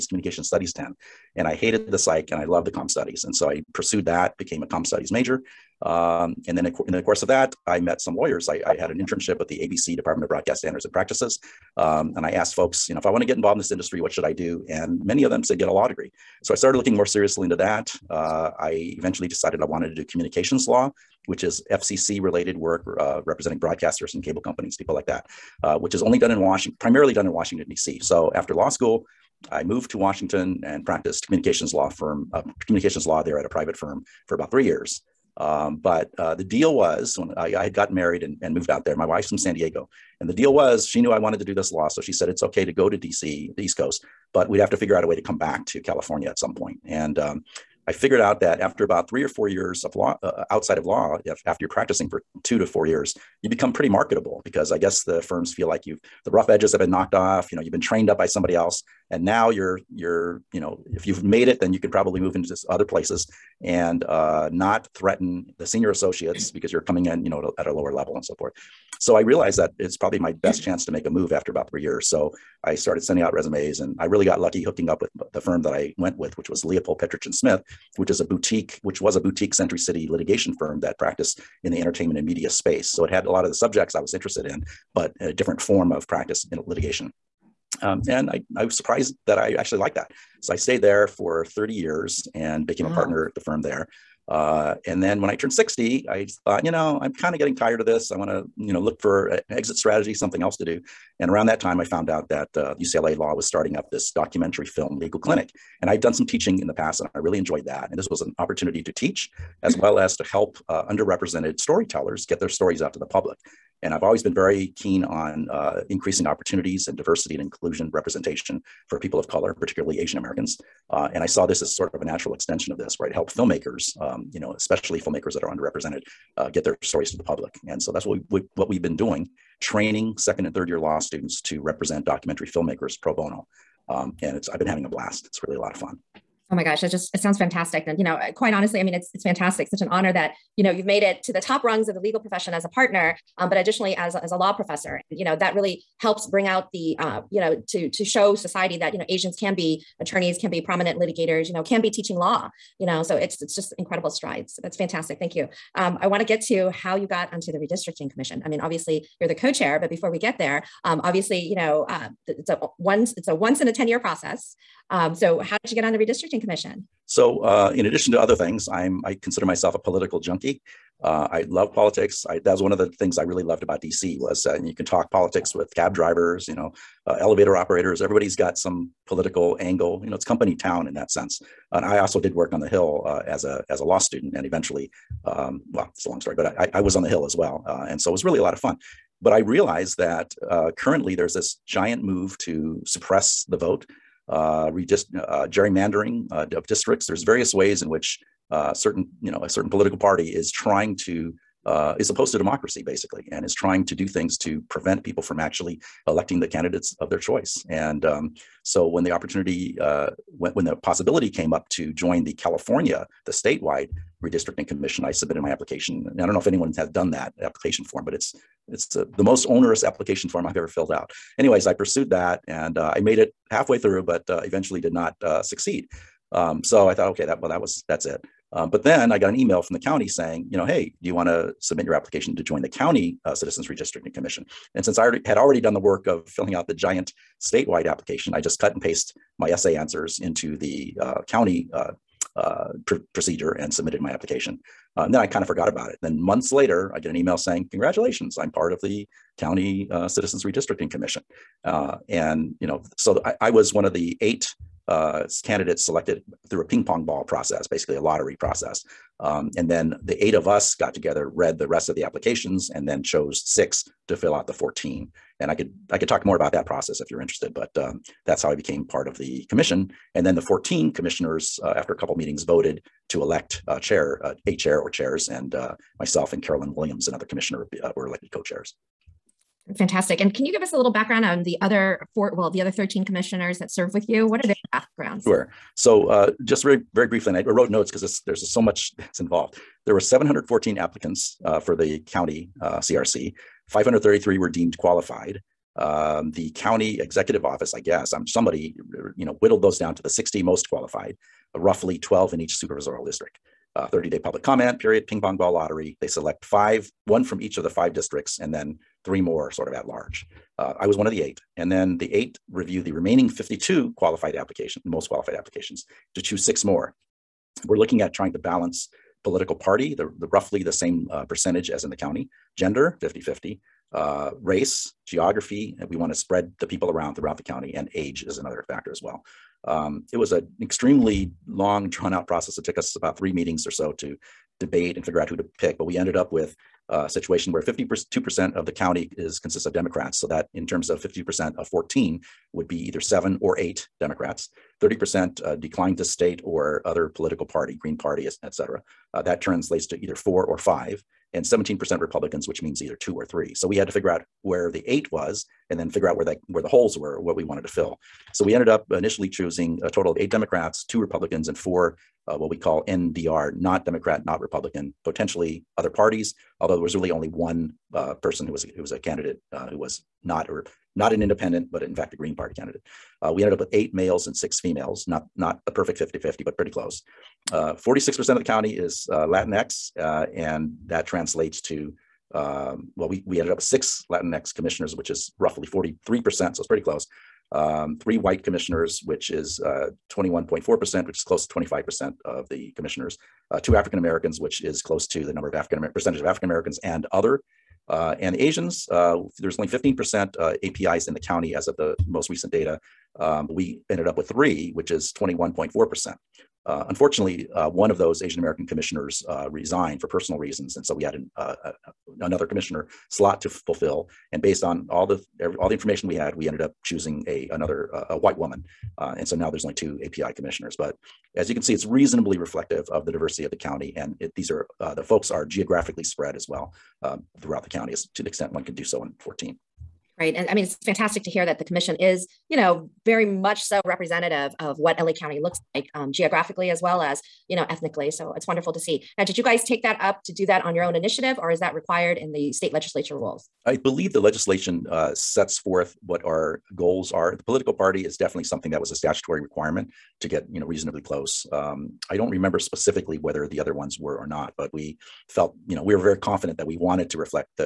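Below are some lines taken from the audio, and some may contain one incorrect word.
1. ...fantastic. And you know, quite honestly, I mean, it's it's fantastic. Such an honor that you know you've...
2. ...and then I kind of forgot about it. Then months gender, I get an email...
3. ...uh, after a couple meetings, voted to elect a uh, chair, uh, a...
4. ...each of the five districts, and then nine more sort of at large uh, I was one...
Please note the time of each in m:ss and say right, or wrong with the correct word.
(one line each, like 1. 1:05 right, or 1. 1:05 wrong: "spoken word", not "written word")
1. 2:17 right
2. 4:05 wrong: "later", not "gender"
3. 4:31 right
4. 5:07 wrong: "three", not "nine".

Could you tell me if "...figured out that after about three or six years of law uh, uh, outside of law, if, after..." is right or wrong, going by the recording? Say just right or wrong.
wrong.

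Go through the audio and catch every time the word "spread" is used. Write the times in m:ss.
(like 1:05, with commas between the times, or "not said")
5:26, 7:06.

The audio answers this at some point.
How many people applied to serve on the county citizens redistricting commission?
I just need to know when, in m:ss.
4:49.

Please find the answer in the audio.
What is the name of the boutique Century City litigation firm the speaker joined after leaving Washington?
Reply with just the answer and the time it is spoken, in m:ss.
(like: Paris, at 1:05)
Leopold Petrich and Smith, at 1:16.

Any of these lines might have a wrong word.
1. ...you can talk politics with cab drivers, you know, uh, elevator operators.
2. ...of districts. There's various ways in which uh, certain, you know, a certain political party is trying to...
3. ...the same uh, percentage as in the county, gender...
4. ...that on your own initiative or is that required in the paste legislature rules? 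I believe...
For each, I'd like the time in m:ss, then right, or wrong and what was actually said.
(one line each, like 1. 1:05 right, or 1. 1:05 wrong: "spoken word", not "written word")
1. 2:54 right
2. 3:16 right
3. 5:20 right
4. 7:20 wrong: "state", not "paste".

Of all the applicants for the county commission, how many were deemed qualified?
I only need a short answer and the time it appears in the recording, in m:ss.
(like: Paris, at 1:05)
533, at 4:53.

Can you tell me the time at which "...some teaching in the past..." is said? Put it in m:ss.
1:46.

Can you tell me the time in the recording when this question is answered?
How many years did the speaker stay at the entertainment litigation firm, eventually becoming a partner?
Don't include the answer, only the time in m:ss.
1:31.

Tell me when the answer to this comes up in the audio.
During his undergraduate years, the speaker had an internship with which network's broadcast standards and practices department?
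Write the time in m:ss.
0:09.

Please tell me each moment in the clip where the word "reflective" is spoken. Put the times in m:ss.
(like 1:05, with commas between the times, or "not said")
7:02.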